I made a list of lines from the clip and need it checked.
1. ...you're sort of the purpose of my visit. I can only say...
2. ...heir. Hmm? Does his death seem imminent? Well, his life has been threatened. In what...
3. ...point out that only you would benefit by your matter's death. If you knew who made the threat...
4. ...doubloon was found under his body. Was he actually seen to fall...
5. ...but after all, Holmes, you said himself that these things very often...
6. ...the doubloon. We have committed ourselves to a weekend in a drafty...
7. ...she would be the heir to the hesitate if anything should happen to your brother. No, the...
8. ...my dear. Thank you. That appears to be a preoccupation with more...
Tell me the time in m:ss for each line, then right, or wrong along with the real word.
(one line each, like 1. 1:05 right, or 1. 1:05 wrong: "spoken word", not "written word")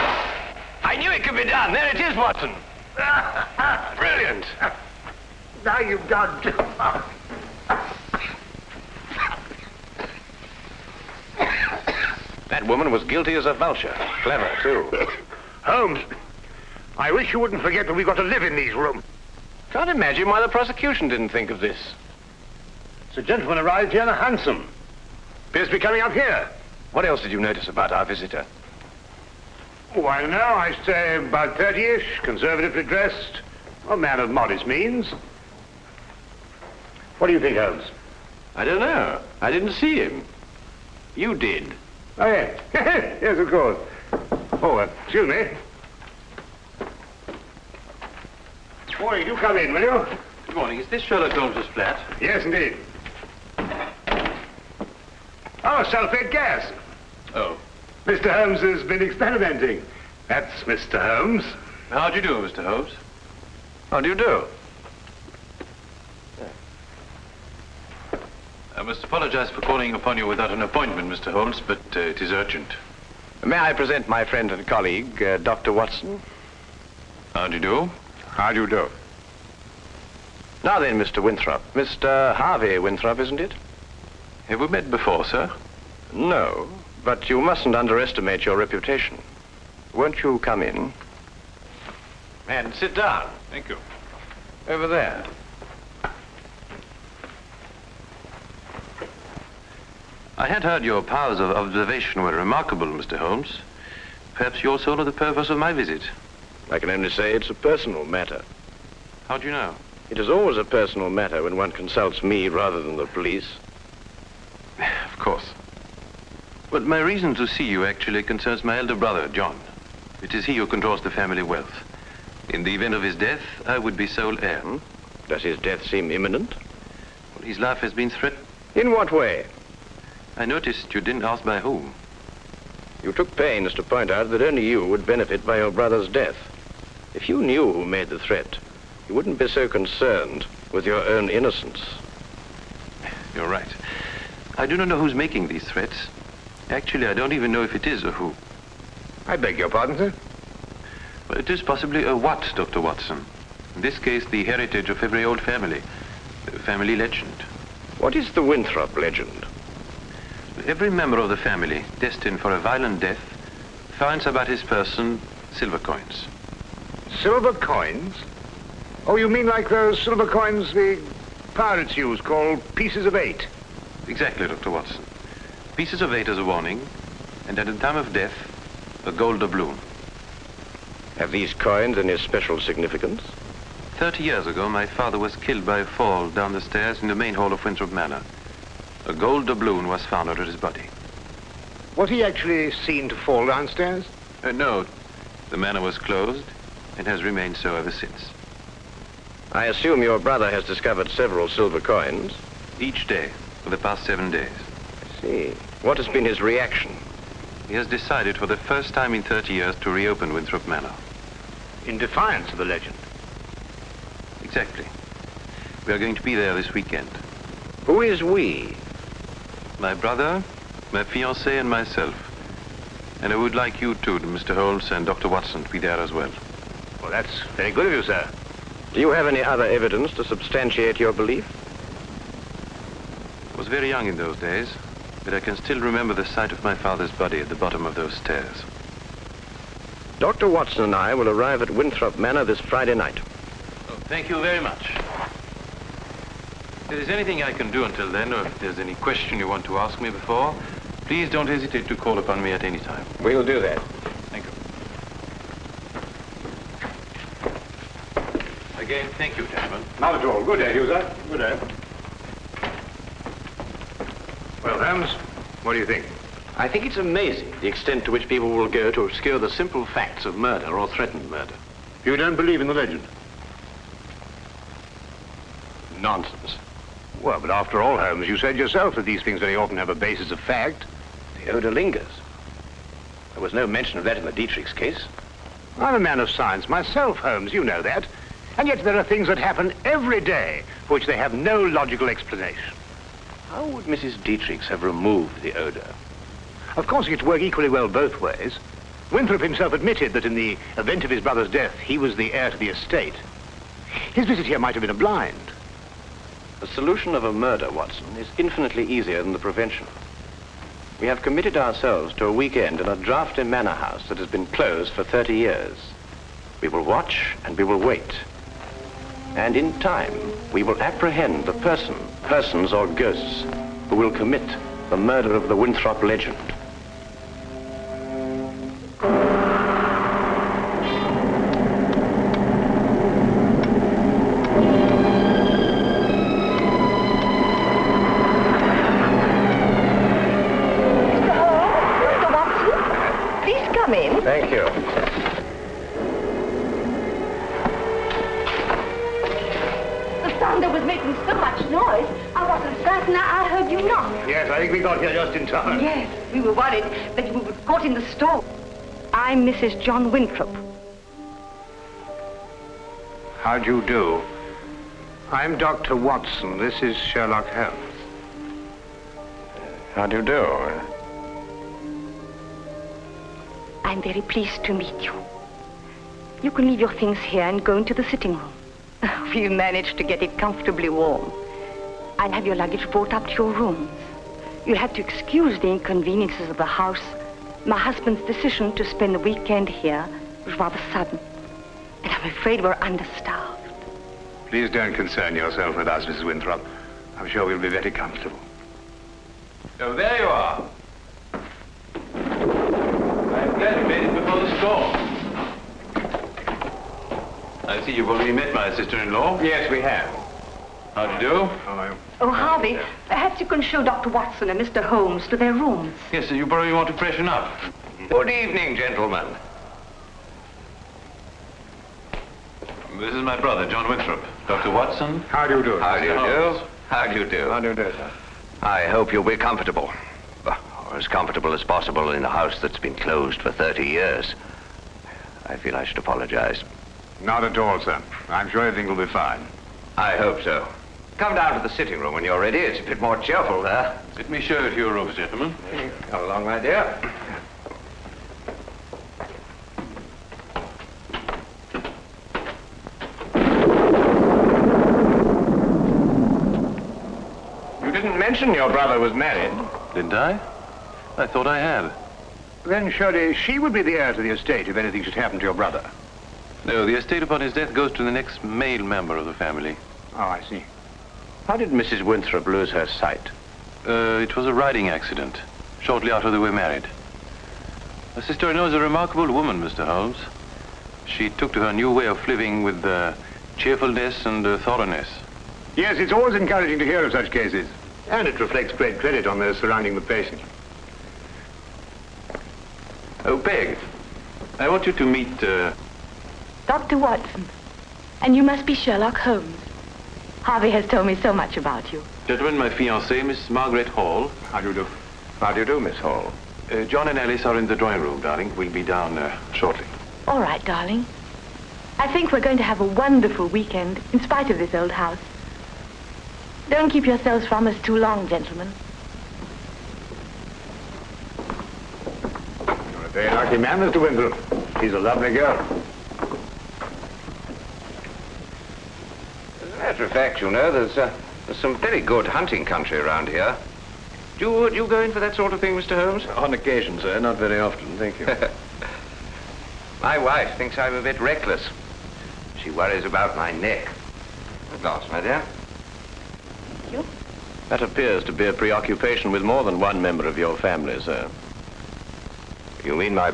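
1. 1:44 right
2. 2:04 right
3. 2:13 wrong: "brother", not "matter"
4. 3:09 right
5. 4:37 wrong: "yourself", not "himself"
6. 5:09 wrong: "prevention", not "doubloon"
7. 7:43 wrong: "estate", not "hesitate"
8. 9:05 right.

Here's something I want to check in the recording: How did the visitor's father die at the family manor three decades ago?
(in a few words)
A fall down the stairs.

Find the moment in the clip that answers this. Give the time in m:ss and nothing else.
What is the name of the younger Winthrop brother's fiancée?
8:23.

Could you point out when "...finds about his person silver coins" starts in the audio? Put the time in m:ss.
2:43.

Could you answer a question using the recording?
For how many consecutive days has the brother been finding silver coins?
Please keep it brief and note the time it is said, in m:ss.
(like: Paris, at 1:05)
7, at 3:24.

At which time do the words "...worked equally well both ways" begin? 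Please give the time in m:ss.
4:57.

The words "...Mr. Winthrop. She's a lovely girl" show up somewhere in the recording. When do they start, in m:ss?
8:43.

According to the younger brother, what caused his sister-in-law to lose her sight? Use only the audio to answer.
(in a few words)
A riding accident.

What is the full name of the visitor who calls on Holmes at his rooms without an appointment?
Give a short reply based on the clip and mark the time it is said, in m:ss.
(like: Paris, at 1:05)
Harvey Winthrop, at 1:21.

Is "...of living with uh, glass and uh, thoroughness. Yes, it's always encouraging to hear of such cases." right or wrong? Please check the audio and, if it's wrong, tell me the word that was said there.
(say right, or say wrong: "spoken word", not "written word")
wrong: "cheerfulness", not "glass".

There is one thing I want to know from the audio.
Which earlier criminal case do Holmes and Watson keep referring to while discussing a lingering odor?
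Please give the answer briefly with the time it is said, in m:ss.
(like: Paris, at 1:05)
The Dietrich case, at 4:44.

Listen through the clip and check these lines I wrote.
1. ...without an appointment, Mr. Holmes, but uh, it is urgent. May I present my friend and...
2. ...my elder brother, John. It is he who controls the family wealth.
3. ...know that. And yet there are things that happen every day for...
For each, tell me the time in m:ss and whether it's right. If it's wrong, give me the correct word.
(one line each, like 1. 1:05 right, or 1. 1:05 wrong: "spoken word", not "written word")
1. 1:10 right
2. 1:58 right
3. 4:47 right.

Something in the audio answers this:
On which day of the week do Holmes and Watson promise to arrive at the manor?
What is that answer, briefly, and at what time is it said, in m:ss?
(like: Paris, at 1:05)
Friday, at 4:02.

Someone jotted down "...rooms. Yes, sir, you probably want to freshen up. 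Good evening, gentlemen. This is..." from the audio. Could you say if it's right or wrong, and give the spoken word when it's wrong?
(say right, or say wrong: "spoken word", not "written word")
right.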